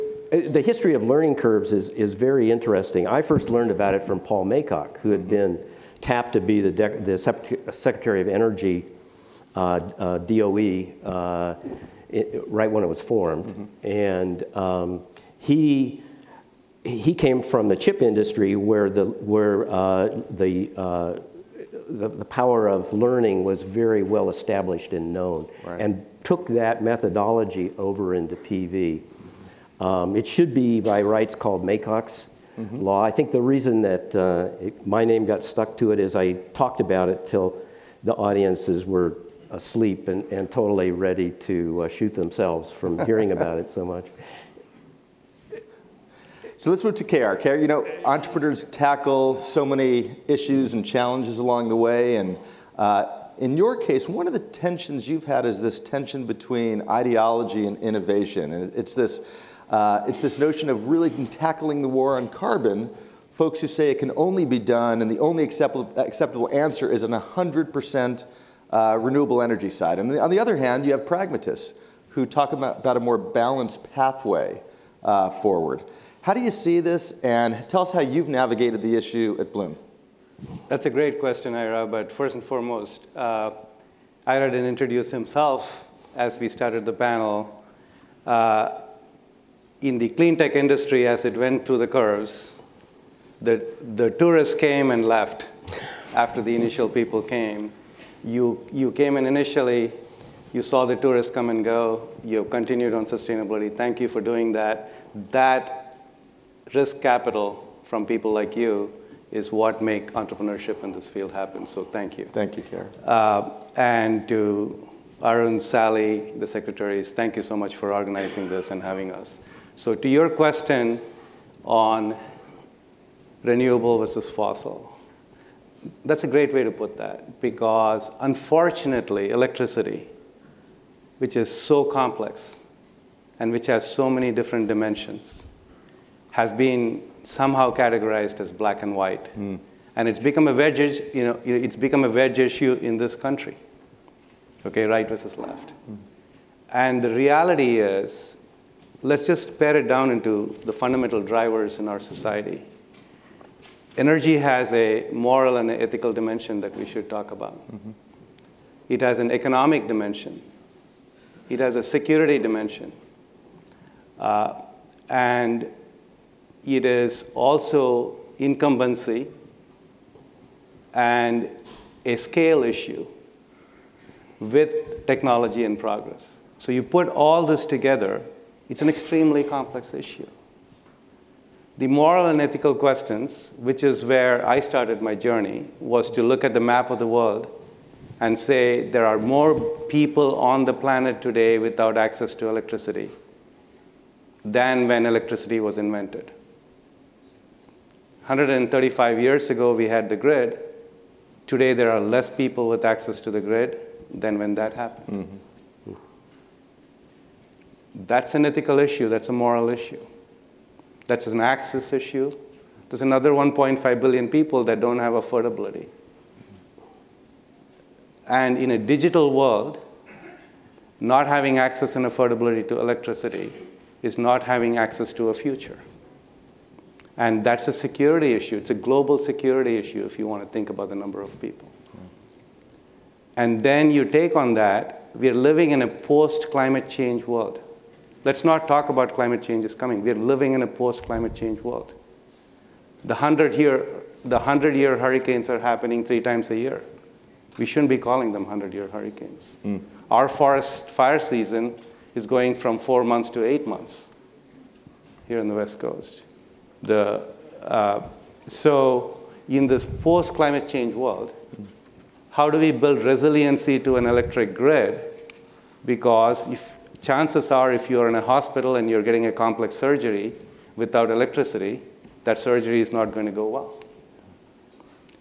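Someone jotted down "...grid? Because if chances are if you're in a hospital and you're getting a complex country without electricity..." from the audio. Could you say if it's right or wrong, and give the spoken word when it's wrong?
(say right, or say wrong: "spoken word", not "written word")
wrong: "surgery", not "country".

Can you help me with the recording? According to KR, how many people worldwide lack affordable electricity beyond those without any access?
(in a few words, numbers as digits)
1.5 billion.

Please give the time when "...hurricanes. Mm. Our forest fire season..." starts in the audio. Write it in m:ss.
4:08.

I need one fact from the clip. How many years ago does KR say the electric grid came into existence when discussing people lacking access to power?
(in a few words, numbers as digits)
135.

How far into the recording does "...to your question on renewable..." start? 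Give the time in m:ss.
1:59.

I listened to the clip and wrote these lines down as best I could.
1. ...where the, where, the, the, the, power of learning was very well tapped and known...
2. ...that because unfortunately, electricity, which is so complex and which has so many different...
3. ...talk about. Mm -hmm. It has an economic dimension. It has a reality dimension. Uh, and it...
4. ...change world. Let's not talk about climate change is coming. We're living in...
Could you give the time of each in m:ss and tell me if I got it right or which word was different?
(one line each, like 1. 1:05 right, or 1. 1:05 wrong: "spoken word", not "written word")
1. 0:18 wrong: "established", not "tapped"
2. 2:06 right
3. 2:37 wrong: "security", not "reality"
4. 3:56 right.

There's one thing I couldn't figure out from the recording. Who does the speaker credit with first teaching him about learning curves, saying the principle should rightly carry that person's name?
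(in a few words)
Paul Maycock.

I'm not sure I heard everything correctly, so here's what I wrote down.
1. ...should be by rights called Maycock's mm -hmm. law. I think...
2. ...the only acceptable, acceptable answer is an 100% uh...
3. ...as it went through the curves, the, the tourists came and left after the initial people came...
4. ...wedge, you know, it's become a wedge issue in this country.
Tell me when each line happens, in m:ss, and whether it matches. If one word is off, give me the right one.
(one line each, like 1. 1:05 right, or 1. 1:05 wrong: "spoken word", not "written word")
1. 0:30 right
2. 1:05 right
3. 1:31 right
4. 2:20 right.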